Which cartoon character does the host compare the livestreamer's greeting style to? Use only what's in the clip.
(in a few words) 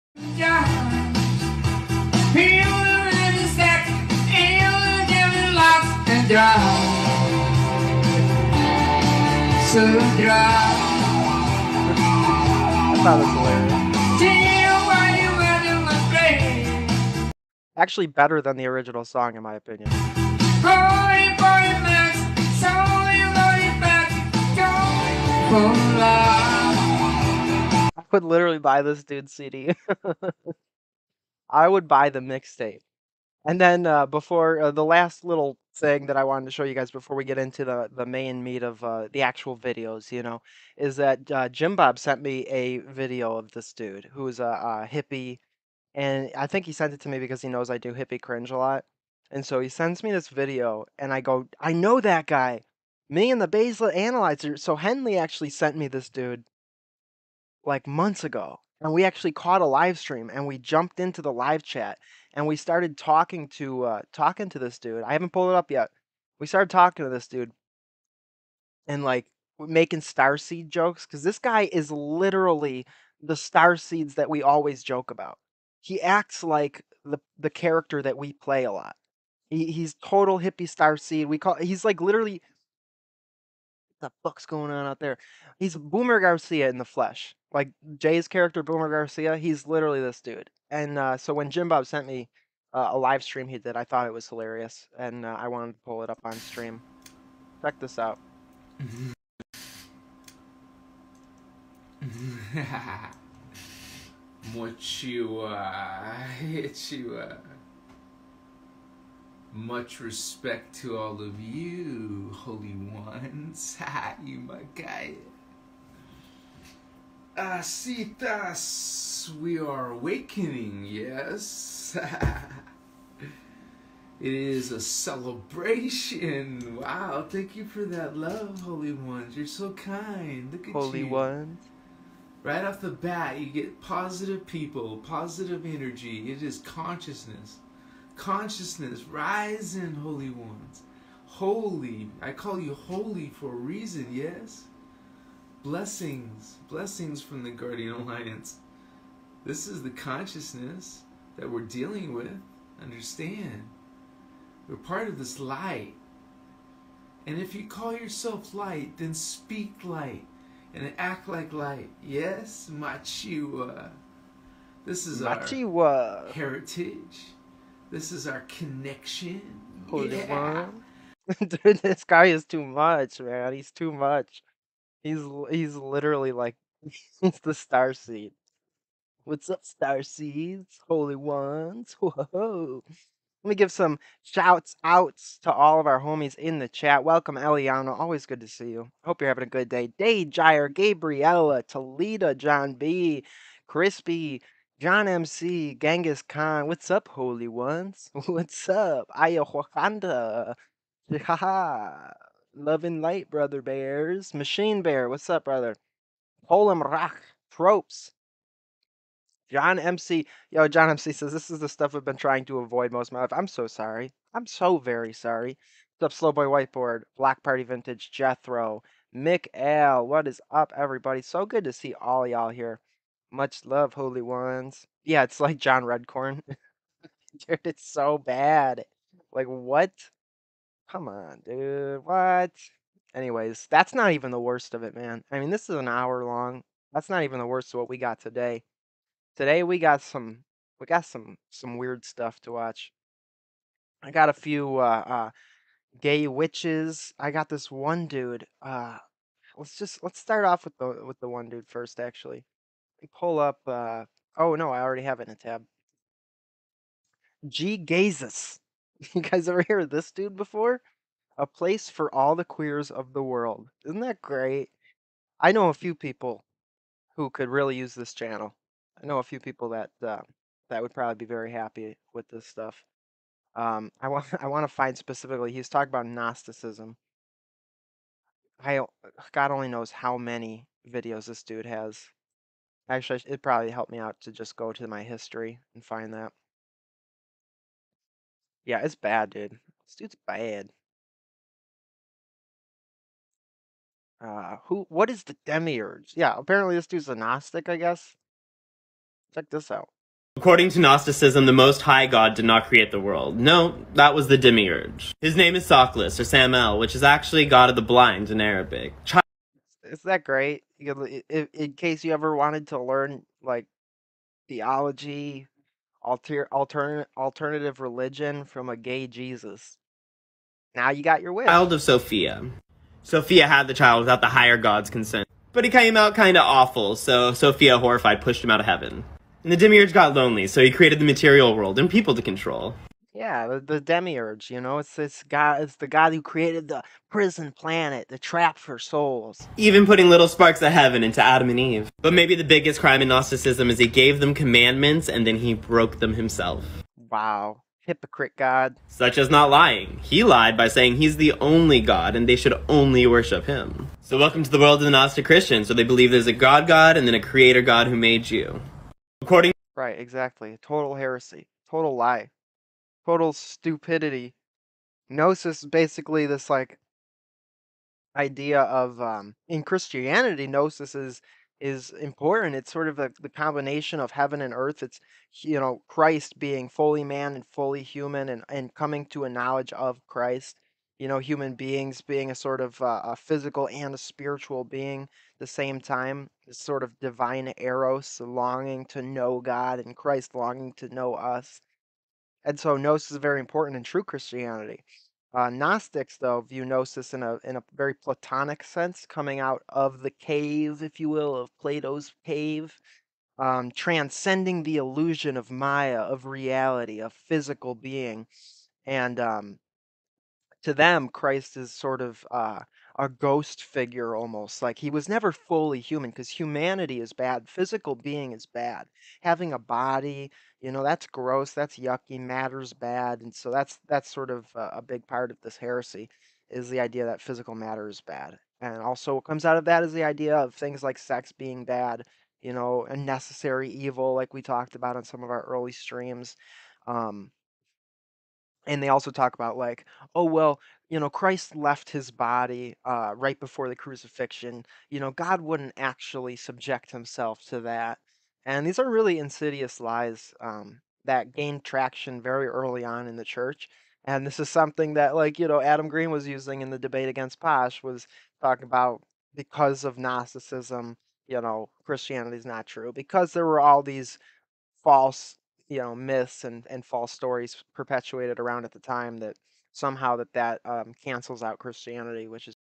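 John Redcorn.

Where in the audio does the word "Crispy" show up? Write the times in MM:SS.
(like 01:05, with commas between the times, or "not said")
03:13.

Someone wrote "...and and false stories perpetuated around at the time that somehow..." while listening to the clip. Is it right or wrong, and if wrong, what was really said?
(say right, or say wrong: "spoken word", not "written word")
right.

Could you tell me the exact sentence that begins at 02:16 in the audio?
It is consciousness consciousness, rising, holy ones.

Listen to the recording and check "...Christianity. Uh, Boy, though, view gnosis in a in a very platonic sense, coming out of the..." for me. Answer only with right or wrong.
wrong.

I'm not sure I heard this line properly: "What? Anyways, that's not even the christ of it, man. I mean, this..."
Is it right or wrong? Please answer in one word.
wrong.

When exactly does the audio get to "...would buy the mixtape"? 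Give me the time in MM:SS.
00:31.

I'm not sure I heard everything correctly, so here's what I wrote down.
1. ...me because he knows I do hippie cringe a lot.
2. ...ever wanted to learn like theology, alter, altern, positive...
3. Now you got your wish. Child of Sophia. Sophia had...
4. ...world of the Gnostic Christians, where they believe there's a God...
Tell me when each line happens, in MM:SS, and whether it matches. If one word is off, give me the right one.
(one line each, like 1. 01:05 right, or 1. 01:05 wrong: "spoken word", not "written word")
1. 00:47 right
2. 05:12 wrong: "alternative", not "positive"
3. 05:20 right
4. 05:54 right.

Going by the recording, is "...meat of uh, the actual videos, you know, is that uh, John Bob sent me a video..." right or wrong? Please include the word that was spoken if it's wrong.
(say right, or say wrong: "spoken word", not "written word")
wrong: "Jim", not "John".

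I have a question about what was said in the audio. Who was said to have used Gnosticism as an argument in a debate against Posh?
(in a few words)
Adam Green.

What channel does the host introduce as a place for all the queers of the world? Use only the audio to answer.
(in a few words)
G Gazes.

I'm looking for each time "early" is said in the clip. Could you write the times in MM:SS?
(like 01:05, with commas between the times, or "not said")
07:15, 07:32.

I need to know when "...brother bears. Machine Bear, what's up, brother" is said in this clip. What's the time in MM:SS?
03:23.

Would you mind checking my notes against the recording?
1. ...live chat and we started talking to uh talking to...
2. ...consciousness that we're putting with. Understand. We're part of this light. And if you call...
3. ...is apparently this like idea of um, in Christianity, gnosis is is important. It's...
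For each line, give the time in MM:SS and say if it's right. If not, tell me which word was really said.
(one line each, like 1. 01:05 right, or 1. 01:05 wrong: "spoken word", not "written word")
1. 01:01 right
2. 02:29 wrong: "dealing", not "putting"
3. 06:05 wrong: "basically", not "apparently".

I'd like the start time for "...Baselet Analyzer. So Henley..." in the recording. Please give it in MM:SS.
00:53.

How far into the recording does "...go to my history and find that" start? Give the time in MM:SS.
04:44.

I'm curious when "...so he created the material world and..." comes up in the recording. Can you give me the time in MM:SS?
05:30.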